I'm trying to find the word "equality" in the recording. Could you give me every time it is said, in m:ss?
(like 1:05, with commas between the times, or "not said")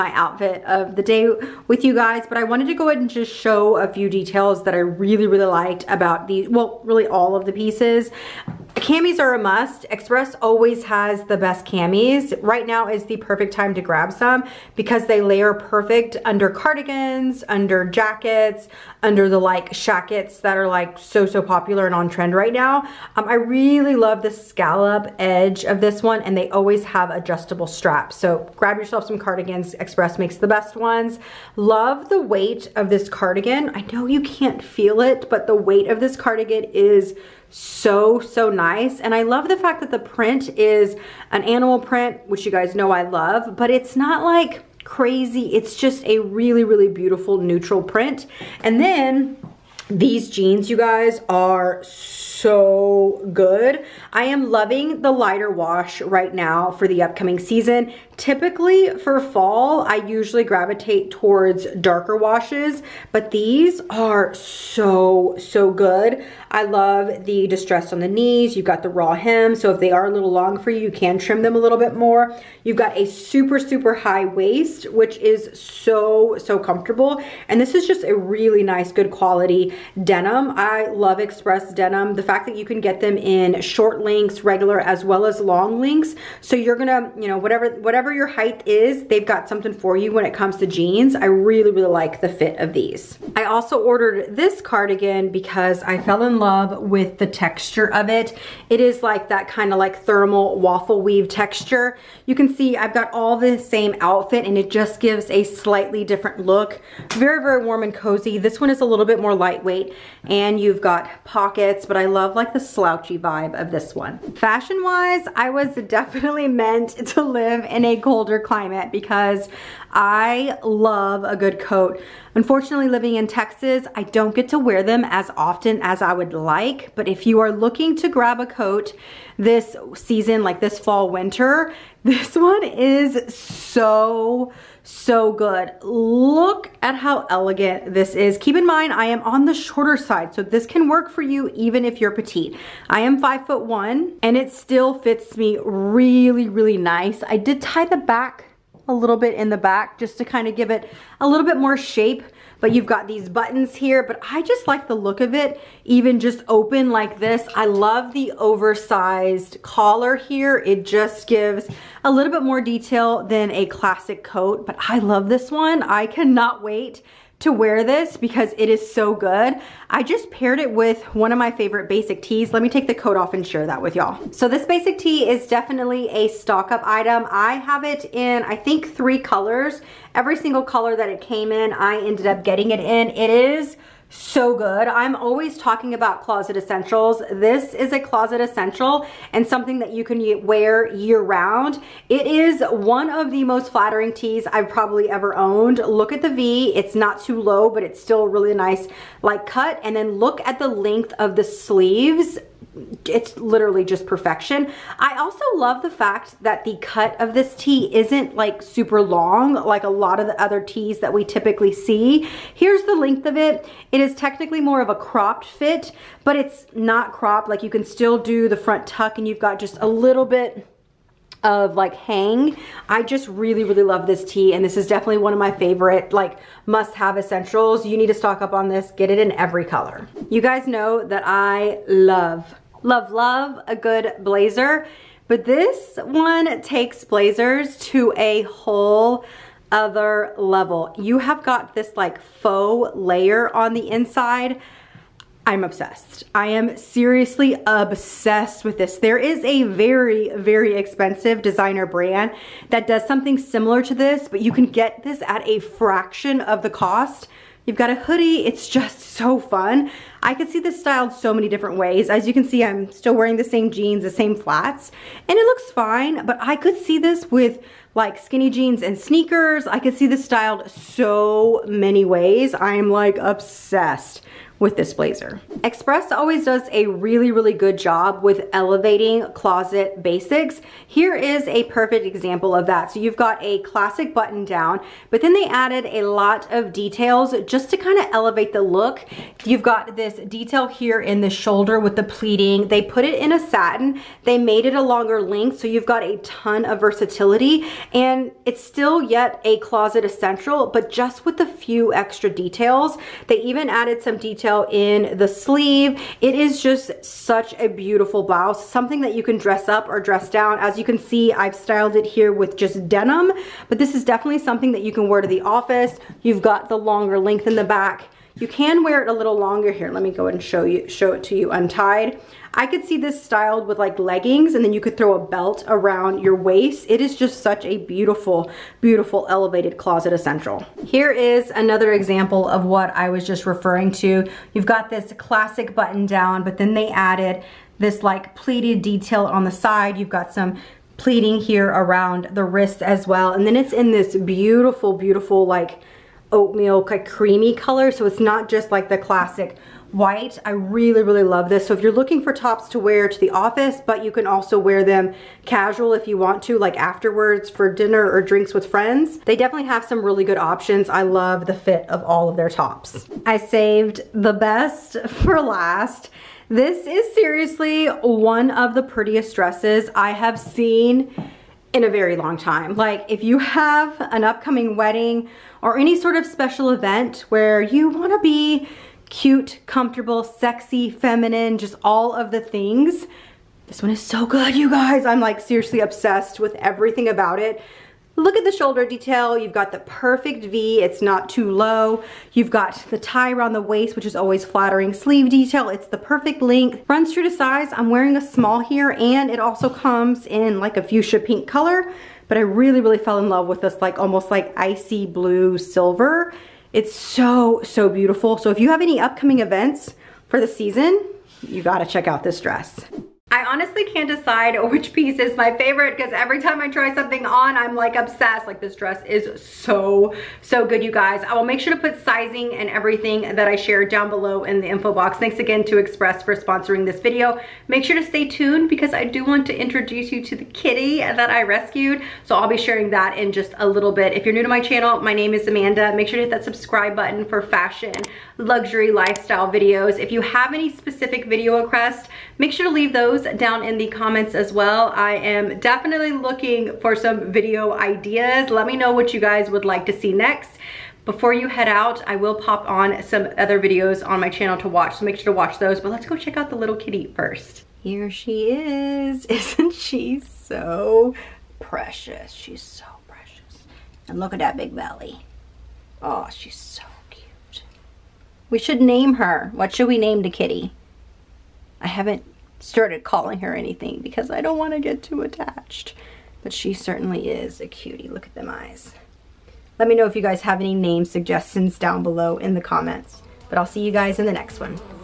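not said.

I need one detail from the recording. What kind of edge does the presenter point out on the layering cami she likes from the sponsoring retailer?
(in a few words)
Scallop edge.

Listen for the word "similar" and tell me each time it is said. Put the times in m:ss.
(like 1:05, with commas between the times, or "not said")
4:13.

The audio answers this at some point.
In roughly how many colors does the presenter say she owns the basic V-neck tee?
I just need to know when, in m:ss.
2:58.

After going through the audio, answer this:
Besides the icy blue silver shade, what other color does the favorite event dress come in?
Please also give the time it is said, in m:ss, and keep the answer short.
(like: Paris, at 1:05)
Fuchsia pink, at 6:40.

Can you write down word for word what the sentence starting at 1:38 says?
It is like that kind of like thermal waffle weave texture.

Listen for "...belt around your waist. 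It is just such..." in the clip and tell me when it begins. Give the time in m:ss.
5:25.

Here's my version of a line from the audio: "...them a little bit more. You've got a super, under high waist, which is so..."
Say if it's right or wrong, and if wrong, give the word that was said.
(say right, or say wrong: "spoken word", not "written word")
wrong: "super", not "under".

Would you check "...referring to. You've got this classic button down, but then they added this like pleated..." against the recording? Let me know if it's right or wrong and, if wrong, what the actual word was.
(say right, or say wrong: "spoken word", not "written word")
right.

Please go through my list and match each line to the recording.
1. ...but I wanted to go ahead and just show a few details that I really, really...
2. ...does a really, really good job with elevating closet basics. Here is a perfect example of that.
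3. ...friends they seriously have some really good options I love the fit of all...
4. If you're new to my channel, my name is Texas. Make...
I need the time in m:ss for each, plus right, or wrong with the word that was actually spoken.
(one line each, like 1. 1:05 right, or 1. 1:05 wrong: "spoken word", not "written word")
1. 0:02 right
2. 4:36 right
3. 5:58 wrong: "definitely", not "seriously"
4. 7:14 wrong: "Amanda", not "Texas".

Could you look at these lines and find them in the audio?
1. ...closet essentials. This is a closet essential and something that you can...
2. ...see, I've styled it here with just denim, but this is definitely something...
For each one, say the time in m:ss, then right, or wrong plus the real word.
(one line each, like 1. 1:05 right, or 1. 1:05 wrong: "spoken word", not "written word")
1. 3:06 right
2. 5:10 right.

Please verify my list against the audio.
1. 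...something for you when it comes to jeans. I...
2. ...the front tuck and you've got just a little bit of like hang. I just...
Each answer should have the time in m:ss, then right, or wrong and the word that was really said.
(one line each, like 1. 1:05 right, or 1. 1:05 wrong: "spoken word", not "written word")
1. 1:29 right
2. 3:38 right.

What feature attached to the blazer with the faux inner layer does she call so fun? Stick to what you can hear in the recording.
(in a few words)
A hoodie.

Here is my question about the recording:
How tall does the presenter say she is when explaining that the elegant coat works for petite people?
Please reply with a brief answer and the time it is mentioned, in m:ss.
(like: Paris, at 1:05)
5 foot 1, at 2:23.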